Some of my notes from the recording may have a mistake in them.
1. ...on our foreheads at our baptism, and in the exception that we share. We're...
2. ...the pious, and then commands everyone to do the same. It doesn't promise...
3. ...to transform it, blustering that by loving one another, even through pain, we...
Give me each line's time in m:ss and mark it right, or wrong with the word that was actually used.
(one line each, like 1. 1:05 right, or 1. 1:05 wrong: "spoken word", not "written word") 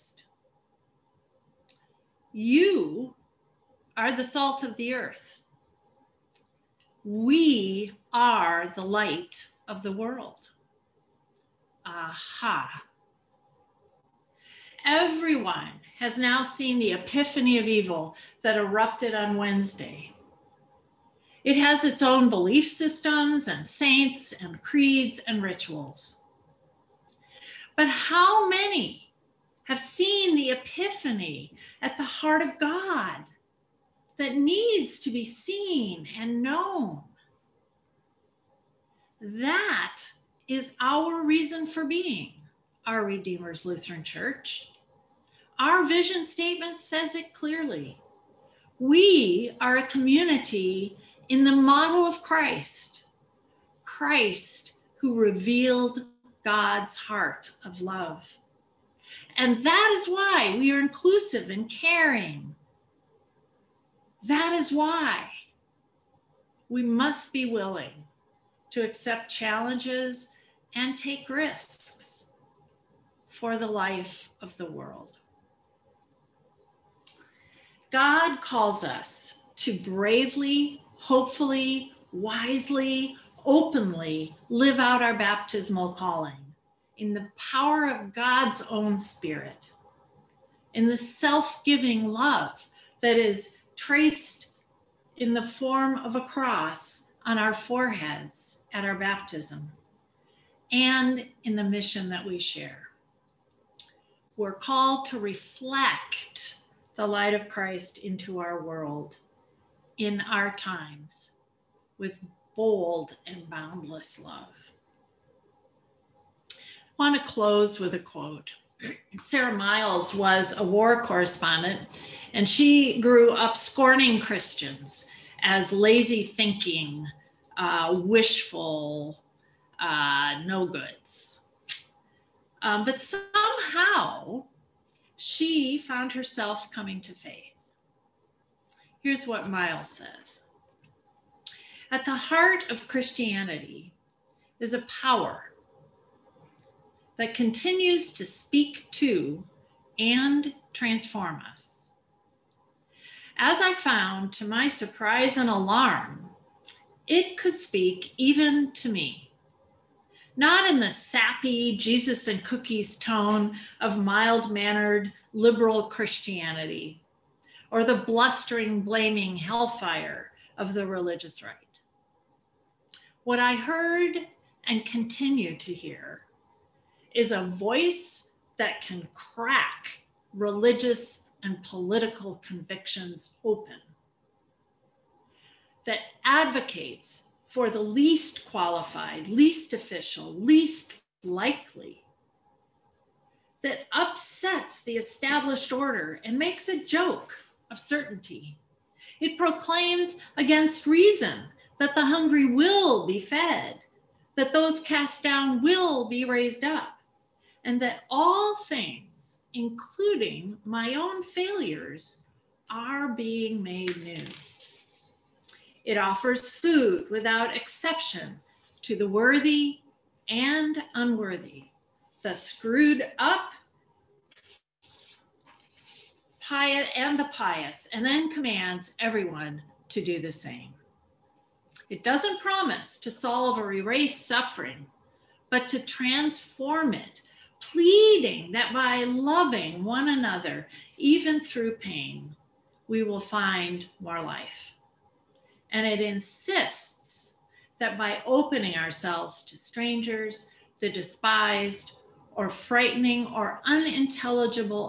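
1. 1:37 wrong: "mission", not "exception"
2. 3:47 right
3. 3:55 wrong: "pleading", not "blustering".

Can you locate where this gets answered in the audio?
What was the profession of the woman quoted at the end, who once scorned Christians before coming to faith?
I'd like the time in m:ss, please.
2:00.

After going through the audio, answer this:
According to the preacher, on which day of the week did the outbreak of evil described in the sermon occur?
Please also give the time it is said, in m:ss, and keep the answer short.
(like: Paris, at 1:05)
Wednesday, at 0:19.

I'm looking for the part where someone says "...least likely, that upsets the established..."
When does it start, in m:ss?
3:10.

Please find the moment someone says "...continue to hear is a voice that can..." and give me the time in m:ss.
2:54.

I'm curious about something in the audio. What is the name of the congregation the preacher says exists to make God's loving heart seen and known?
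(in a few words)
Redeemer's Lutheran Church.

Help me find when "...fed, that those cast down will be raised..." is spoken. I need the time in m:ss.
3:23.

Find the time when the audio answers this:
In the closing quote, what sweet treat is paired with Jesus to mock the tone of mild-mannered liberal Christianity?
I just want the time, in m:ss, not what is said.
2:42.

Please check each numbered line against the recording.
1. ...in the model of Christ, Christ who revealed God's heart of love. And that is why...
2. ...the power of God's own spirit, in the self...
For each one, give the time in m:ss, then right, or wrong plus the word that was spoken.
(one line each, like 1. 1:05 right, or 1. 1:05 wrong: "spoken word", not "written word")
1. 0:51 right
2. 1:27 right.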